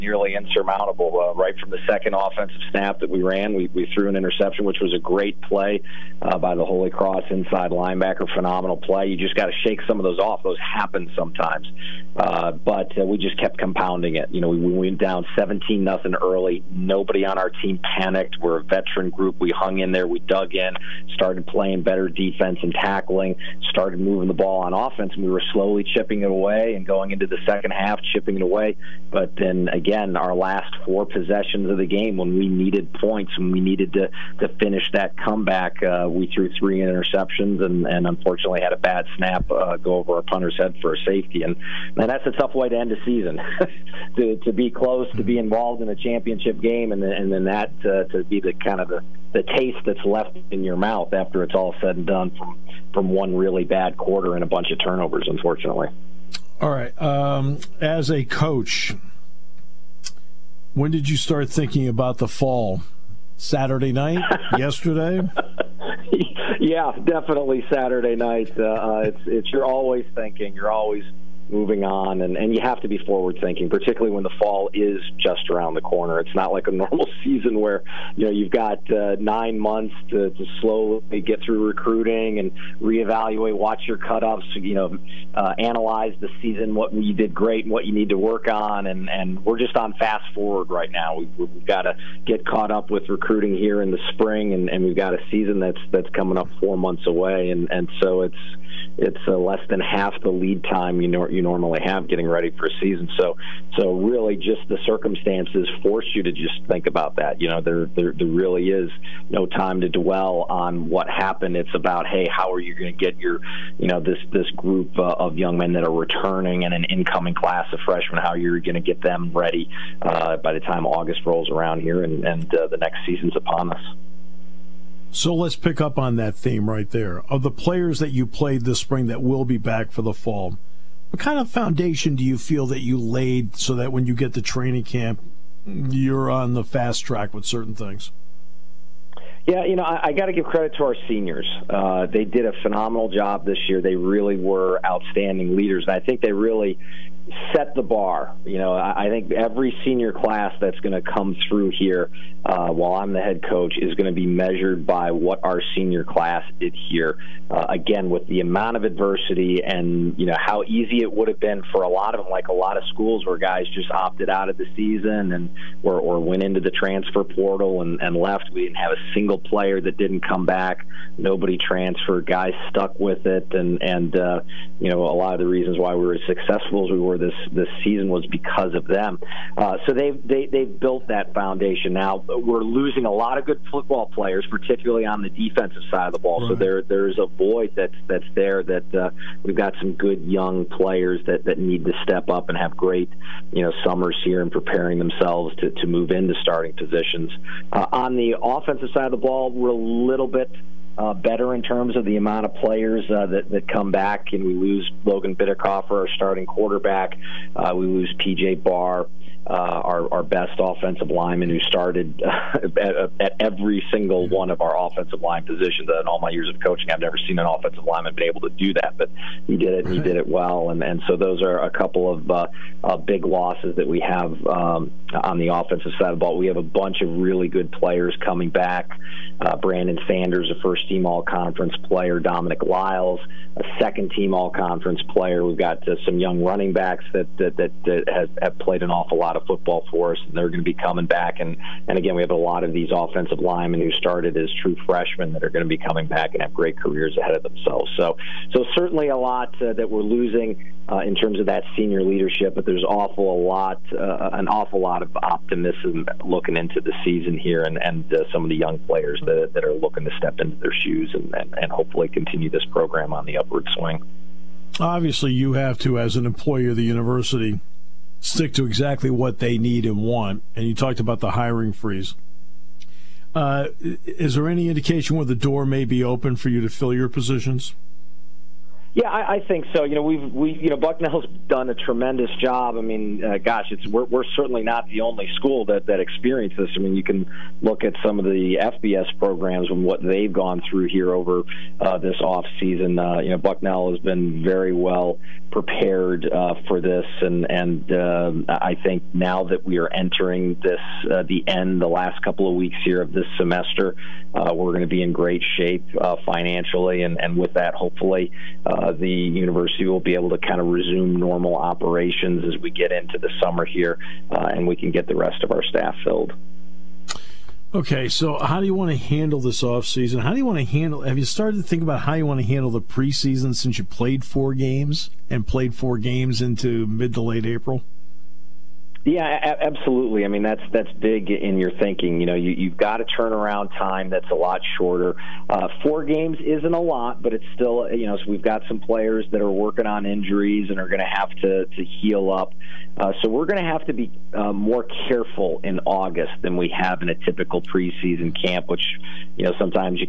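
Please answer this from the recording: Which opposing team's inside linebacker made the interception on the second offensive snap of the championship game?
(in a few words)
Holy Cross.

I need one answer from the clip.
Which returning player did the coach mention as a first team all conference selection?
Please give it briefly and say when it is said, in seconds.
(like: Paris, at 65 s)
Brandon Sanders, at 229 s.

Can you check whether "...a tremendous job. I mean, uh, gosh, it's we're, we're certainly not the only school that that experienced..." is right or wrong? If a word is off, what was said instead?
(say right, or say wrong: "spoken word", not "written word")
right.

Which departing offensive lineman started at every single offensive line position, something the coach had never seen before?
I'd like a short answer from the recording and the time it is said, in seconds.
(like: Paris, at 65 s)
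PJ Barr, at 208 s.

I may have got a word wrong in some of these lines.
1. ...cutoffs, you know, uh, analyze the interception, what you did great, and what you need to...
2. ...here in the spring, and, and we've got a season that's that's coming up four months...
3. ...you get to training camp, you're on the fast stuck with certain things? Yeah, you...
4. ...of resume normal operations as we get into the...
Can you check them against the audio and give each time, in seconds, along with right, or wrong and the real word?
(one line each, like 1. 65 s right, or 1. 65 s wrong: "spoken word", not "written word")
1. 83 s wrong: "season", not "interception"
2. 93 s right
3. 134 s wrong: "track", not "stuck"
4. 310 s right.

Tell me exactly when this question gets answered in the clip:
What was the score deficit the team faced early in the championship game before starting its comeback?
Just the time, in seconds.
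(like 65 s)
15 s.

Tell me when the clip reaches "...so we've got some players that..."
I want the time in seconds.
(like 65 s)
338 s.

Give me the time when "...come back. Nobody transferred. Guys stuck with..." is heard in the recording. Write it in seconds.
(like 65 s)
170 s.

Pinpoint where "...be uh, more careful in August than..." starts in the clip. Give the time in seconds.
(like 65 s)
343 s.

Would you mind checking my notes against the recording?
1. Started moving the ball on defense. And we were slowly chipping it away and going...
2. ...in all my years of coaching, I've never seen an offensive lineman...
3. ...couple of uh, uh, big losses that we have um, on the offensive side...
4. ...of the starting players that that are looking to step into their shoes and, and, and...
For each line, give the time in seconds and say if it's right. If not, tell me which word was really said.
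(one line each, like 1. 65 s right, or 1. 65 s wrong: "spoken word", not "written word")
1. 23 s wrong: "offense", not "defense"
2. 215 s right
3. 221 s right
4. 258 s wrong: "young", not "starting".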